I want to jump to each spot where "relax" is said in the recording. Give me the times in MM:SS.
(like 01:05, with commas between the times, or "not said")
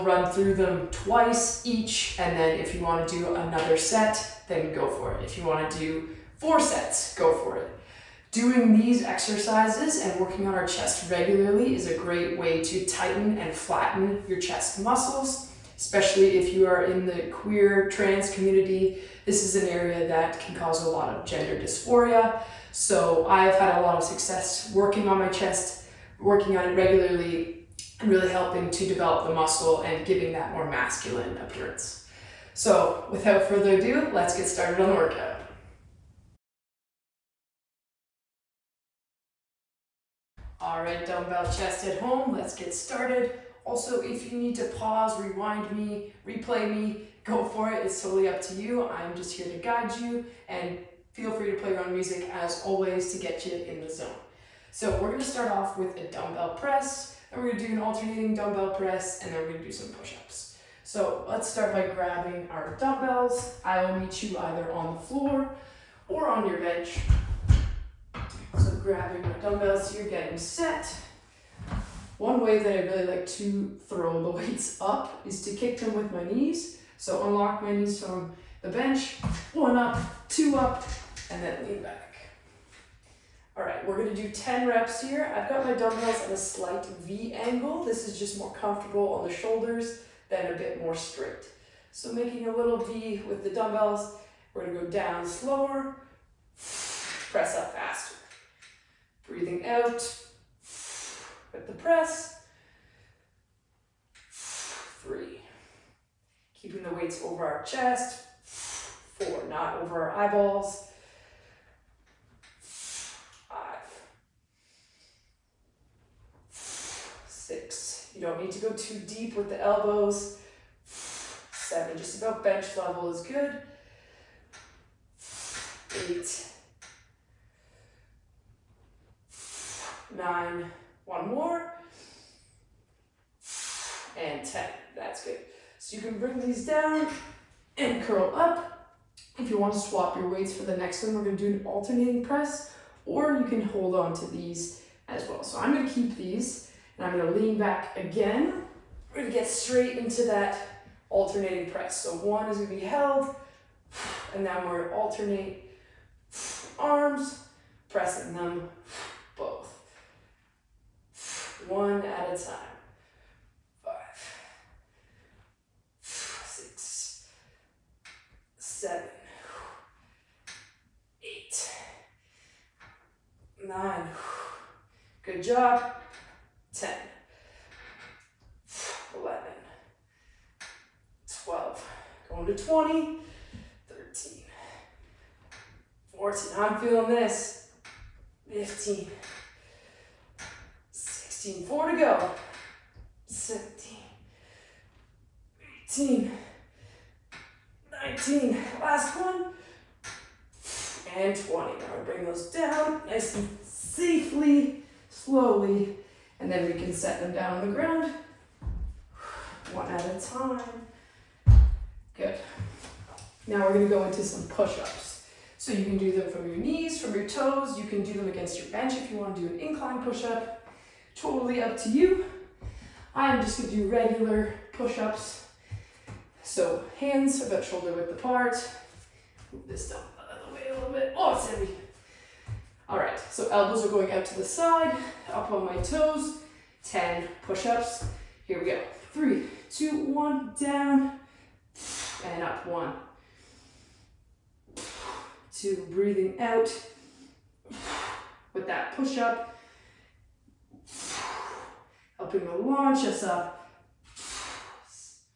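not said.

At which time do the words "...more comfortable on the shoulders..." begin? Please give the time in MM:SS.
01:28.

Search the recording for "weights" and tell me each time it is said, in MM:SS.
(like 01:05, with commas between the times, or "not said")
01:14, 01:46, 02:20.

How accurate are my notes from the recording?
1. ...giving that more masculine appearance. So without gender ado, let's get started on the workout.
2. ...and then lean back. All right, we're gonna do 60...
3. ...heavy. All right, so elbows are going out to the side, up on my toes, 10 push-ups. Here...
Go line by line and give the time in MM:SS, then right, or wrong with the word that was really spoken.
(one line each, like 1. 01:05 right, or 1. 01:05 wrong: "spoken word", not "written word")
1. 00:30 wrong: "further", not "gender"
2. 01:21 wrong: "10", not "60"
3. 03:51 right.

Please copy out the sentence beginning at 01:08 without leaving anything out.
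So grabbing your dumbbells, so you're getting set.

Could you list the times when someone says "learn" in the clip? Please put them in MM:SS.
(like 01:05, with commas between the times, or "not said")
not said.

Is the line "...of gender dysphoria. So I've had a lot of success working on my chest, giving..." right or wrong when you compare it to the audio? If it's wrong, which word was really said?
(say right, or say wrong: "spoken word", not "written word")
wrong: "working", not "giving".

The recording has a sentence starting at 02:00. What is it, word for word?
Seven, just about bench level is good.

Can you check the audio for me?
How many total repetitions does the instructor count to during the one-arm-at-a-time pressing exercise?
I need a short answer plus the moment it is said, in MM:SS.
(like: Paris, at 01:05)
20, at 03:02.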